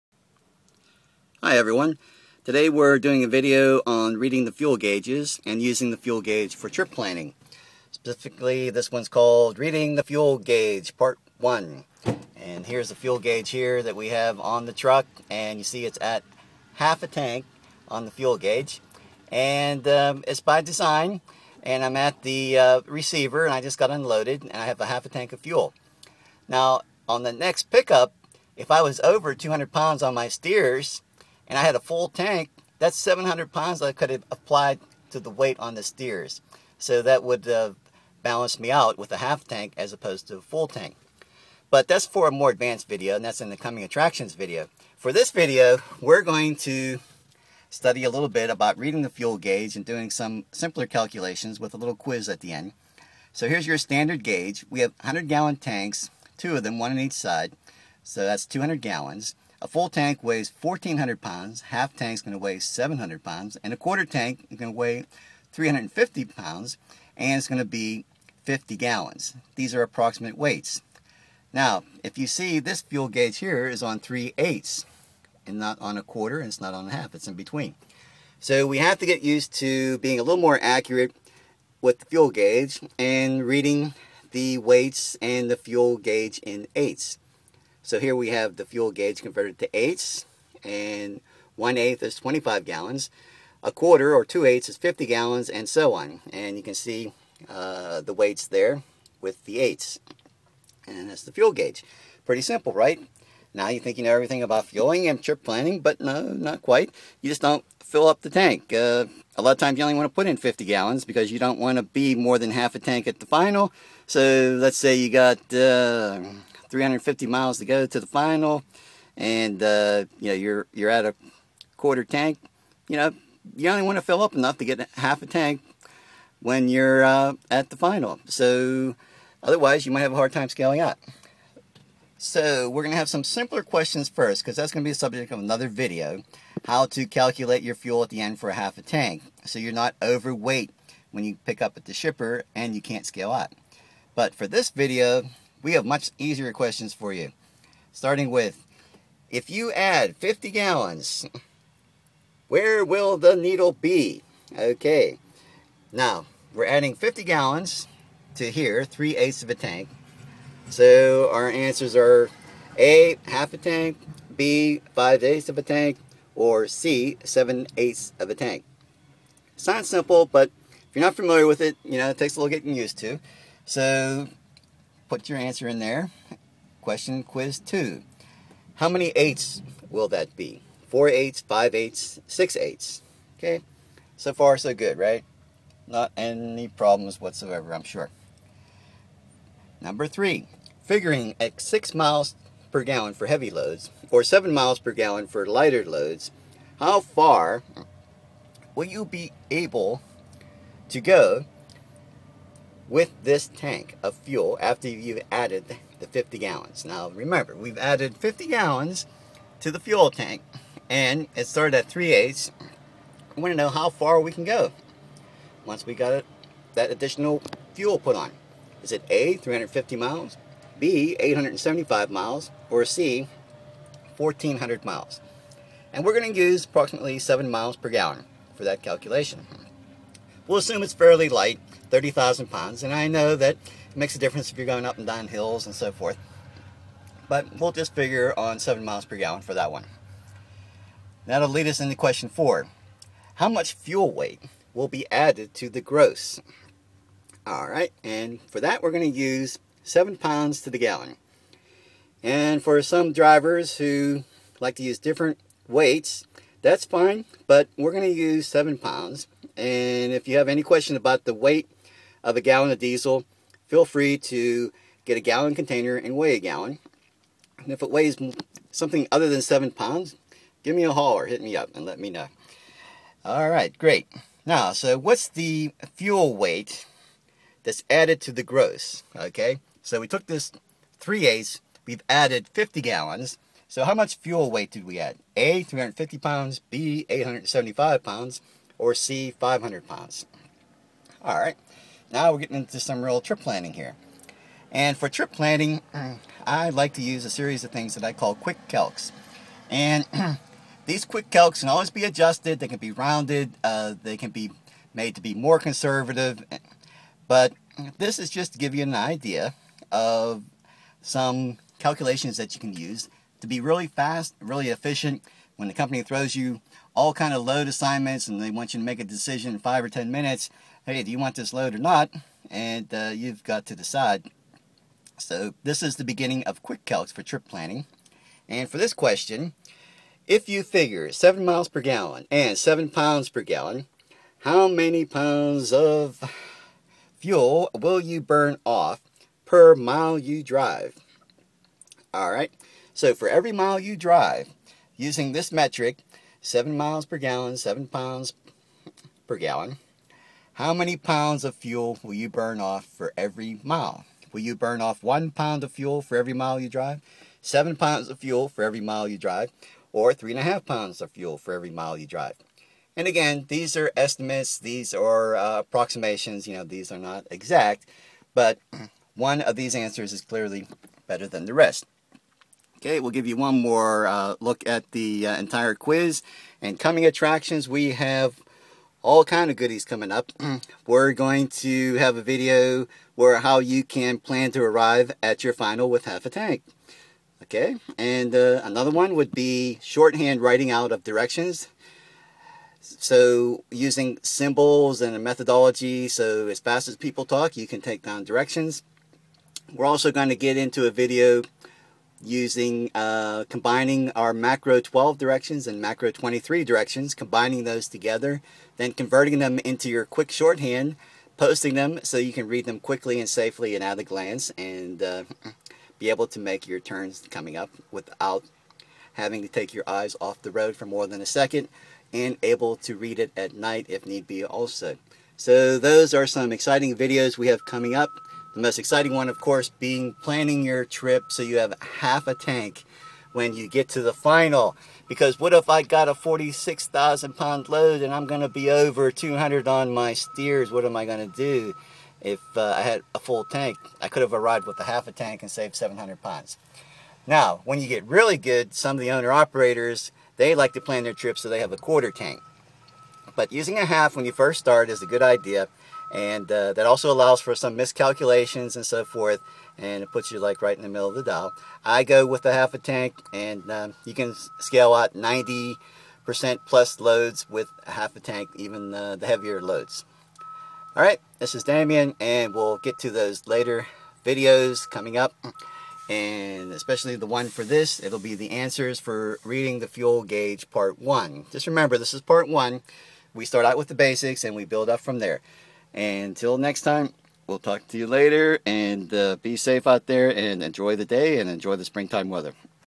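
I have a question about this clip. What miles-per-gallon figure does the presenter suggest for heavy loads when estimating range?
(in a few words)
6.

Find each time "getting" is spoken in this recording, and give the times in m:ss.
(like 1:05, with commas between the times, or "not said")
2:52, 4:52.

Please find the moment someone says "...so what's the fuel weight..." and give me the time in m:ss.
4:34.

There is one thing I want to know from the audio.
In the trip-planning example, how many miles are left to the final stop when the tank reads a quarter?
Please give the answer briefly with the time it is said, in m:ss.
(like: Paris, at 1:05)
350 miles, at 1:56.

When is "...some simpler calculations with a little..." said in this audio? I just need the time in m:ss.
0:50.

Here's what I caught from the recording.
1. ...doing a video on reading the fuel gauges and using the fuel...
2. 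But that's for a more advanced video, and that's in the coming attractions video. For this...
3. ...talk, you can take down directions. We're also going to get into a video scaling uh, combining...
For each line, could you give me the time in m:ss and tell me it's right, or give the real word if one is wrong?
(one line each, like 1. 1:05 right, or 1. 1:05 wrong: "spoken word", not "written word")
1. 0:02 right
2. 0:41 right
3. 6:37 wrong: "using", not "scaling".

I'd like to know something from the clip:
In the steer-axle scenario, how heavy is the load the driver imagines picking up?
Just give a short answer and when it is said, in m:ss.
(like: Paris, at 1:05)
46,000 pounds, at 7:16.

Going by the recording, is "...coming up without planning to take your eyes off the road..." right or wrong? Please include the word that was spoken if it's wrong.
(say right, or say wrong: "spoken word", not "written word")
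wrong: "having", not "planning".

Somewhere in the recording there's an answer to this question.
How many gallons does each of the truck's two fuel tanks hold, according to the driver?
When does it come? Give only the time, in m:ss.
0:55.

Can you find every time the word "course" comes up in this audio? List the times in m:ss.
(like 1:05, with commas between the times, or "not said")
7:09.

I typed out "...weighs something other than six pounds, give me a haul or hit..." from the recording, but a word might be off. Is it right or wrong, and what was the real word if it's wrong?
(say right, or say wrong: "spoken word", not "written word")
wrong: "seven", not "six".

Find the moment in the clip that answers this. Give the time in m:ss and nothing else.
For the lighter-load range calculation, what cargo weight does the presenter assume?
3:51.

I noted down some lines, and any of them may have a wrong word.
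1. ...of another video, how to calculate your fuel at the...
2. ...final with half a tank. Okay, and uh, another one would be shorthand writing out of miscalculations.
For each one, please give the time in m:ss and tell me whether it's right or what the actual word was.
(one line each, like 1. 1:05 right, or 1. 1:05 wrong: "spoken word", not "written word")
1. 2:15 right
2. 6:25 wrong: "directions", not "miscalculations".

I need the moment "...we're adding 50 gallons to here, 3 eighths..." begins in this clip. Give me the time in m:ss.
2:36.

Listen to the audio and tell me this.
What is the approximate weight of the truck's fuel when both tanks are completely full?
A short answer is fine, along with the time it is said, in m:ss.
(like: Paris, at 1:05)
1,400 pounds, at 0:59.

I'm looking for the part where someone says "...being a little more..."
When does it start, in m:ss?
1:19.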